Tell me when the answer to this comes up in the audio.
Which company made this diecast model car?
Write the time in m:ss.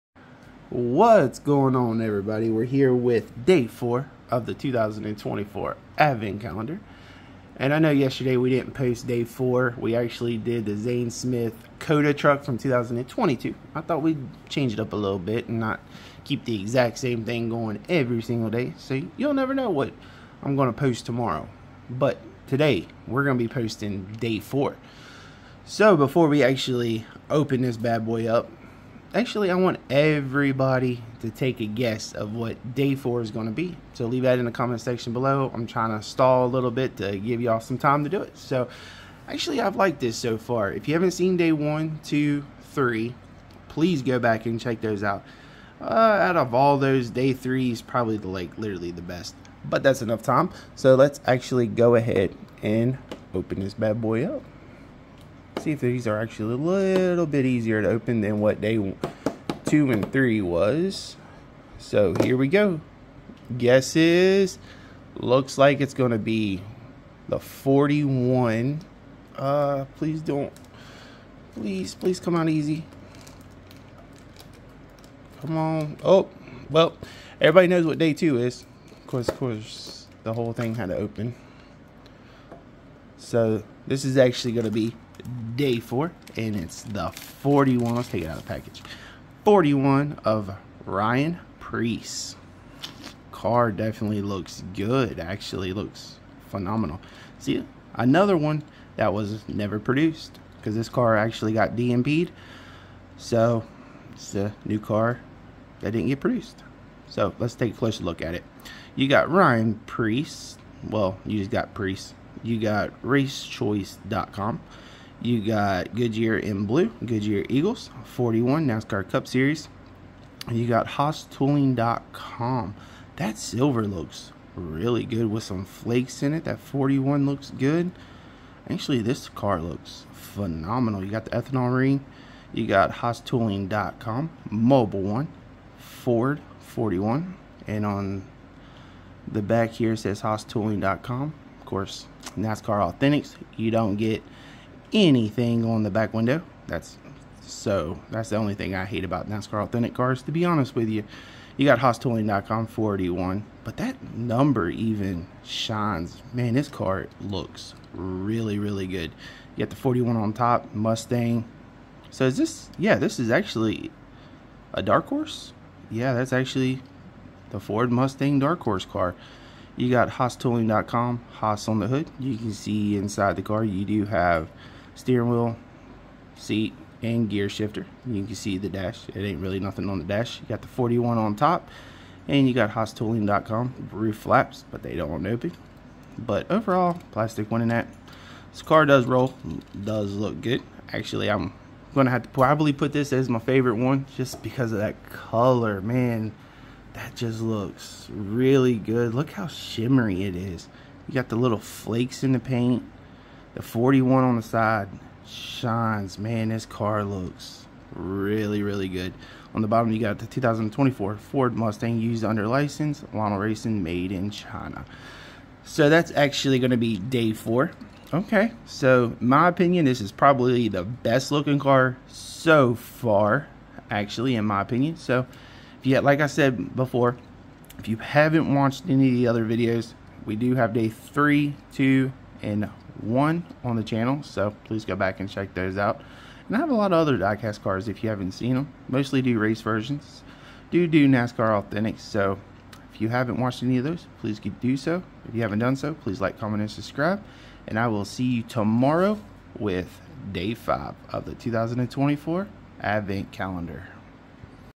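3:33.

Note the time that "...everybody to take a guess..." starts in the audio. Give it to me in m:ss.
0:29.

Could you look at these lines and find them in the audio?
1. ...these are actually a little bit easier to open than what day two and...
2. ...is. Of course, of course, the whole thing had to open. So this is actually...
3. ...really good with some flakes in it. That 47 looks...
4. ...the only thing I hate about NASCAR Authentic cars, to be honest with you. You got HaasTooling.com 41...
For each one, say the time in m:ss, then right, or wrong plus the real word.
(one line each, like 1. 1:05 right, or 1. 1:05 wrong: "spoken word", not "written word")
1. 0:55 right
2. 1:18 right
3. 2:04 wrong: "41", not "47"
4. 2:28 right.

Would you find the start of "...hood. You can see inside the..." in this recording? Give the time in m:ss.
2:51.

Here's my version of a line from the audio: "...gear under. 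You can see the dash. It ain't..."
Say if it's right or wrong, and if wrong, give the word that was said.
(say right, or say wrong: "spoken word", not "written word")
wrong: "shifter", not "under".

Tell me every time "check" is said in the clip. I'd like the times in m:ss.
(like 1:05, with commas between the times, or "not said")
0:44, 3:55.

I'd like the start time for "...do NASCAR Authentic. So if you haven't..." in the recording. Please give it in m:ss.
4:00.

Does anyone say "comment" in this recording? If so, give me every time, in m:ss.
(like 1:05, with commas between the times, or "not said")
0:34, 4:06.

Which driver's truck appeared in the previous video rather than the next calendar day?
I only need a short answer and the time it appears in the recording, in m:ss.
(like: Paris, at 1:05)
Zane Smith, at 0:10.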